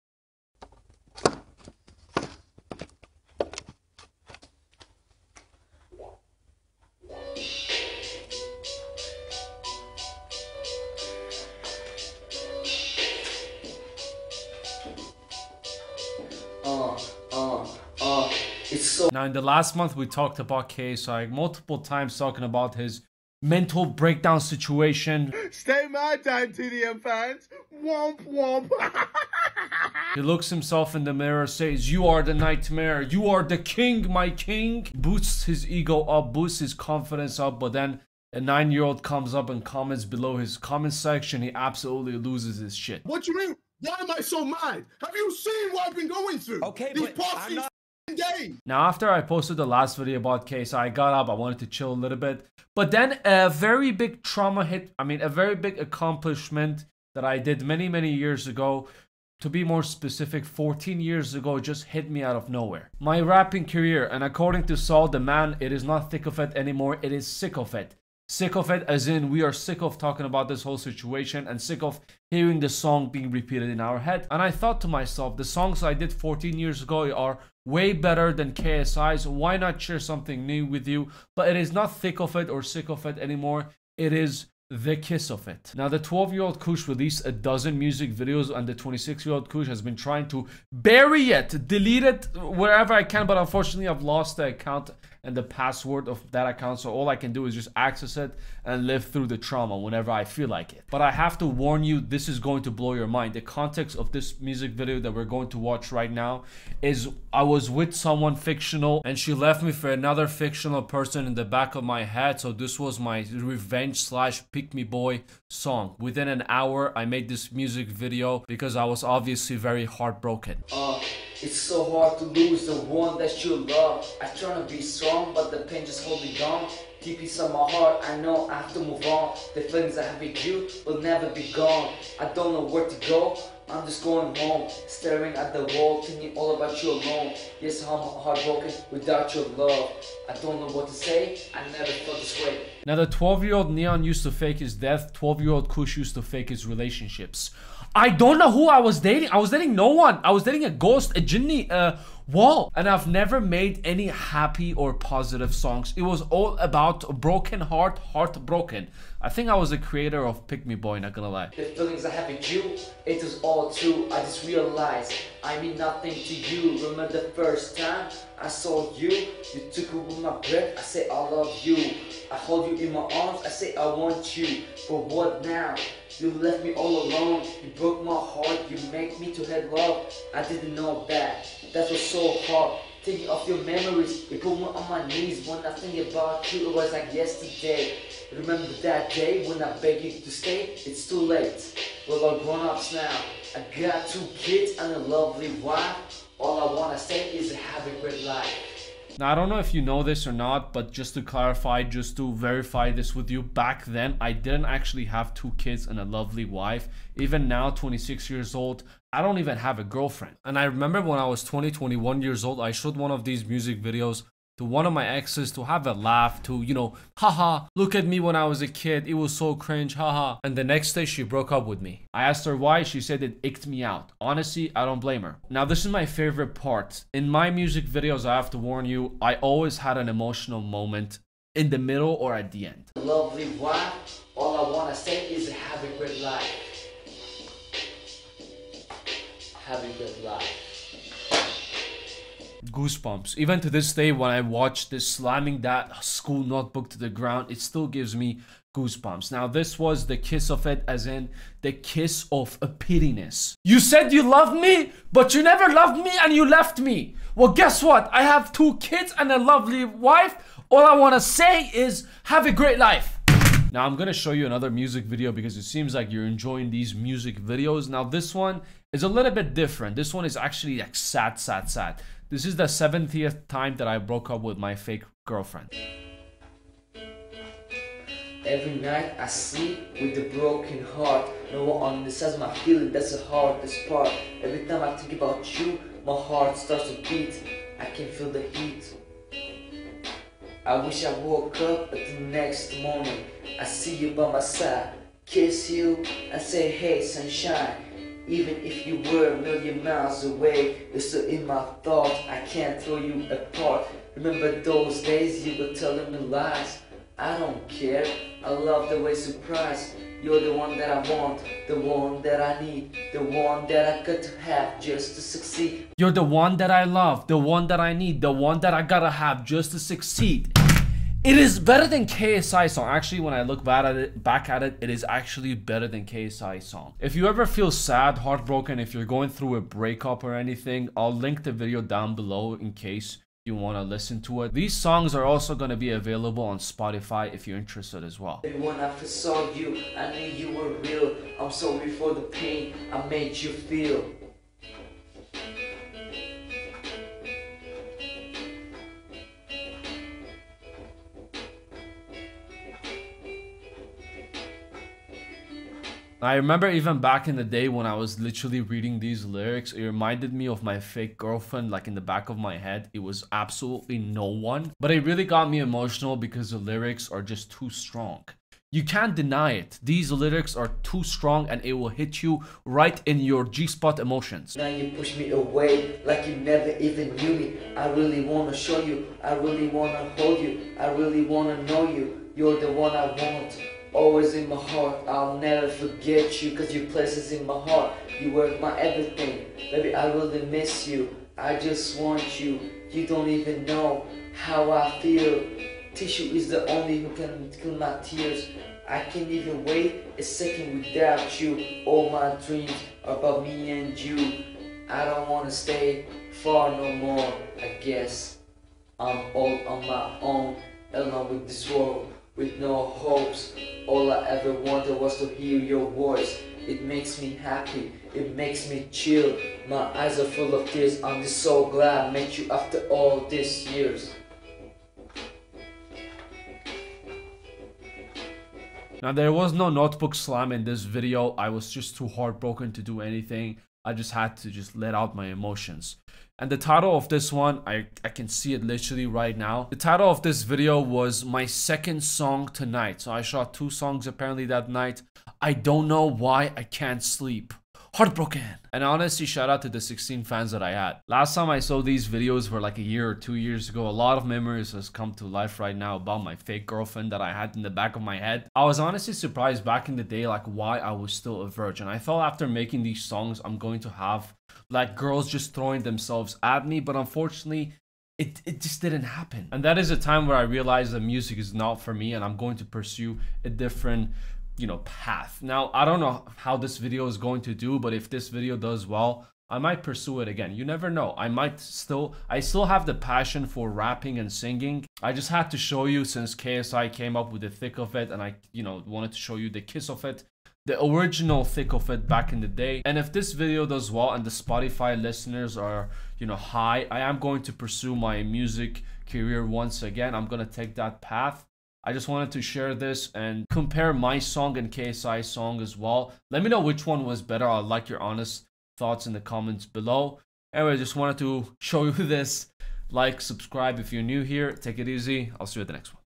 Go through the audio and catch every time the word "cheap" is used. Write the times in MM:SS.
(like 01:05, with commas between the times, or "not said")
not said.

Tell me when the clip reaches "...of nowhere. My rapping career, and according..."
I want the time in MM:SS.
01:02.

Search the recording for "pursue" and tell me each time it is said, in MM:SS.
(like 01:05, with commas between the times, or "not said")
07:52, 07:59, 08:17.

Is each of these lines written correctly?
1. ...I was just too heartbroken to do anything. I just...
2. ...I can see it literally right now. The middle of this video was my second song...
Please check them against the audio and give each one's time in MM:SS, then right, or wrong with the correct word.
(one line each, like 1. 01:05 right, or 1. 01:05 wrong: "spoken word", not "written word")
1. 07:11 right
2. 07:18 wrong: "title", not "middle".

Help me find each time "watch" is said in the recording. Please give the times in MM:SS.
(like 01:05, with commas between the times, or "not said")
01:45, 04:04.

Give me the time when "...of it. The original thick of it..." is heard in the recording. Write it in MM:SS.
08:09.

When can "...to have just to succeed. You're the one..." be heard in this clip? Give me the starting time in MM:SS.
05:14.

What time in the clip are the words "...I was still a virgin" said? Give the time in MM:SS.
07:40.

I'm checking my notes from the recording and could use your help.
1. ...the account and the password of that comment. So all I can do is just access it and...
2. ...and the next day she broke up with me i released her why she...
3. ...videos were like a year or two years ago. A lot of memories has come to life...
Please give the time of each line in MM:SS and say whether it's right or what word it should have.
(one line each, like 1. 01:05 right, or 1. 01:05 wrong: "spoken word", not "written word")
1. 01:34 wrong: "account", not "comment"
2. 03:40 wrong: "asked", not "released"
3. 07:32 right.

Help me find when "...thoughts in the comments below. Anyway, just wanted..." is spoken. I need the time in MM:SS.
08:28.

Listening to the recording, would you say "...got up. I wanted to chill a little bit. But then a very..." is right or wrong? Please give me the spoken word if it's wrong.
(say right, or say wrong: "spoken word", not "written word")
right.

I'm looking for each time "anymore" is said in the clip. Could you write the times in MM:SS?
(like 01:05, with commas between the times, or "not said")
01:06, 01:23.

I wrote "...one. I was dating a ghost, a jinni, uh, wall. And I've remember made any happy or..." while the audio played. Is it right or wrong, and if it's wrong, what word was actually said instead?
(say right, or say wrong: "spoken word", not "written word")
wrong: "never", not "remember".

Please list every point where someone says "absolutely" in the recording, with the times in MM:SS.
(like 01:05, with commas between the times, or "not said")
00:41, 06:03.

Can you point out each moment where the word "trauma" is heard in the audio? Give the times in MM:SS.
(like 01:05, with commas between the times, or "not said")
00:54, 01:39.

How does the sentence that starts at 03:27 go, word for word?
Even now, 26 years old, I don't even have a girlfriend.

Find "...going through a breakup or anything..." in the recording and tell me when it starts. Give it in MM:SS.
05:29.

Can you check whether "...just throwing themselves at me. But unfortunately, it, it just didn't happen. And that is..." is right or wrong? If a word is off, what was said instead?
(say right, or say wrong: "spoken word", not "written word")
right.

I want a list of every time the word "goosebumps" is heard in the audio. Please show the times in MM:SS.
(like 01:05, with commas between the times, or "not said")
04:02, 04:08.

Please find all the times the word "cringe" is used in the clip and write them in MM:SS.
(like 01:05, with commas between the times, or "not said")
03:39.